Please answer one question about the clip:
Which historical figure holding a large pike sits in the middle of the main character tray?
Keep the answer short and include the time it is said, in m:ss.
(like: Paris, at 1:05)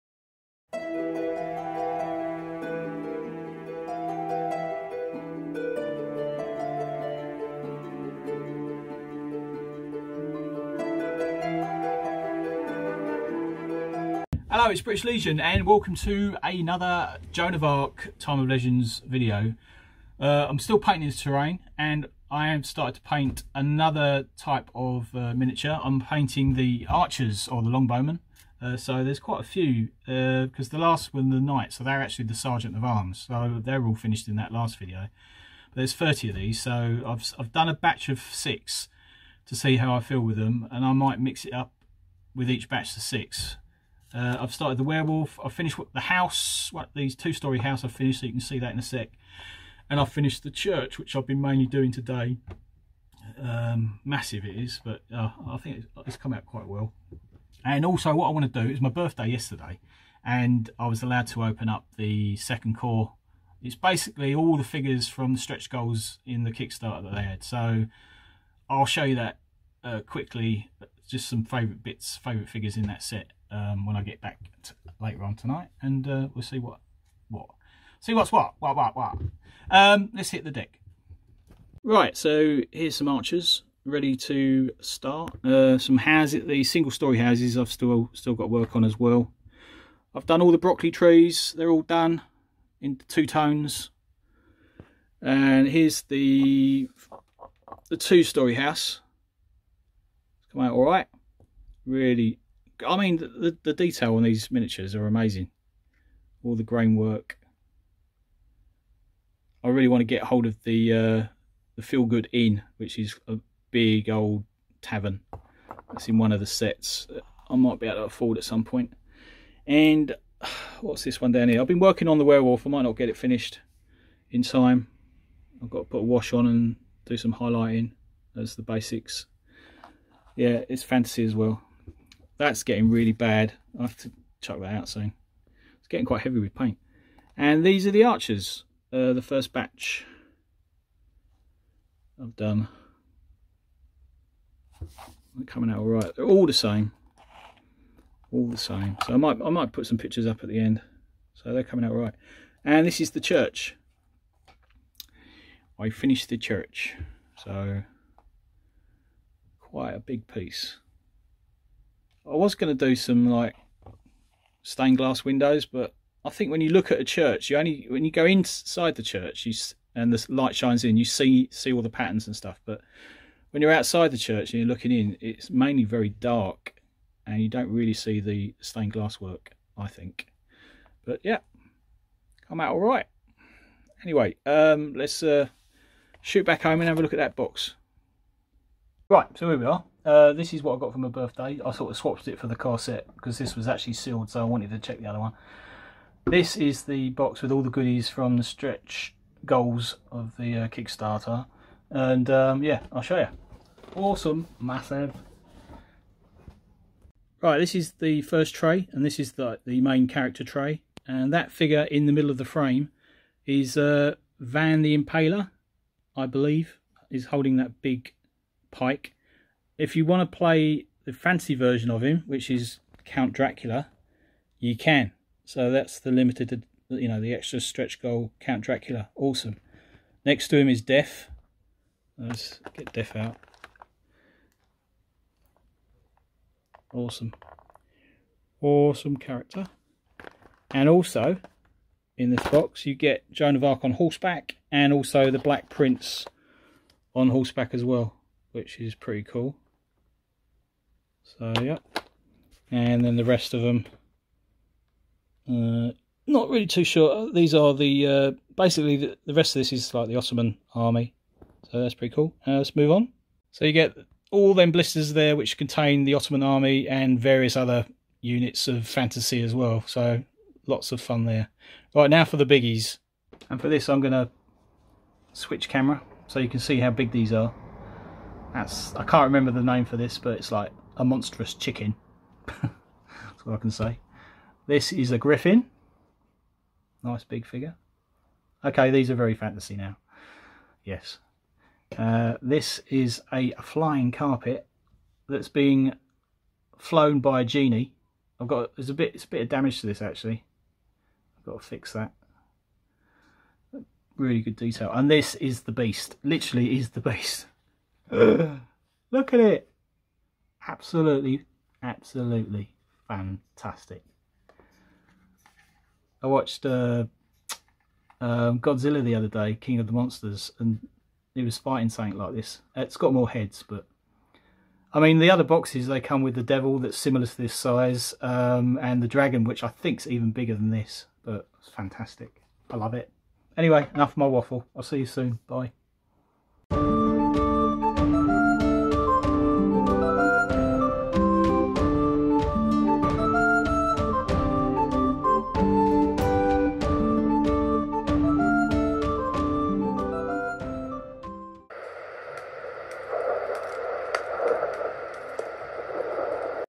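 Vlad the Impaler, at 3:34.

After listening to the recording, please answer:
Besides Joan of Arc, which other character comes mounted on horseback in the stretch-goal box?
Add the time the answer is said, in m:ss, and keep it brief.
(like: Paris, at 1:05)
Black Prince, at 4:05.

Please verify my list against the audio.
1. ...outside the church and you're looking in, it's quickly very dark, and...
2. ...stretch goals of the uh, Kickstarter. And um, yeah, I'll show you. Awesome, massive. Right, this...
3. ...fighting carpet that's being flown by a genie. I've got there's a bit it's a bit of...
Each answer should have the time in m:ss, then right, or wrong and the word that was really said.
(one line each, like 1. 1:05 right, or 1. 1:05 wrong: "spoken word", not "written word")
1. 2:53 wrong: "mainly", not "quickly"
2. 3:18 right
3. 4:53 wrong: "flying", not "fighting".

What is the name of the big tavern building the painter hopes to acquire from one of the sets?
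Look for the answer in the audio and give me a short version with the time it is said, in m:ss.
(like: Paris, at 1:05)
Feel Good Inn, at 1:51.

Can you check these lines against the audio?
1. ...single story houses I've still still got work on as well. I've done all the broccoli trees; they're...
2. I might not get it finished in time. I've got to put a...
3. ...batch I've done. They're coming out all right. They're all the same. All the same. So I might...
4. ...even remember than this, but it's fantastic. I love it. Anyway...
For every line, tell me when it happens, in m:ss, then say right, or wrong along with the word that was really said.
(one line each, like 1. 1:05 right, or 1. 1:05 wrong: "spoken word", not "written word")
1. 1:26 right
2. 2:02 right
3. 2:19 right
4. 5:30 wrong: "bigger", not "remember".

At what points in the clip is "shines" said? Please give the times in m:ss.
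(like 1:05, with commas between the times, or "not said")
2:50.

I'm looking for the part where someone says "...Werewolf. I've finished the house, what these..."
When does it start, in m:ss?
0:44.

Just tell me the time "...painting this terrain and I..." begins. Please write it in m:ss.
0:20.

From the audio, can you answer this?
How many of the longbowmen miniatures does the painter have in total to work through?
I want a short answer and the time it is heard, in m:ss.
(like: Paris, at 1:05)
30, at 0:35.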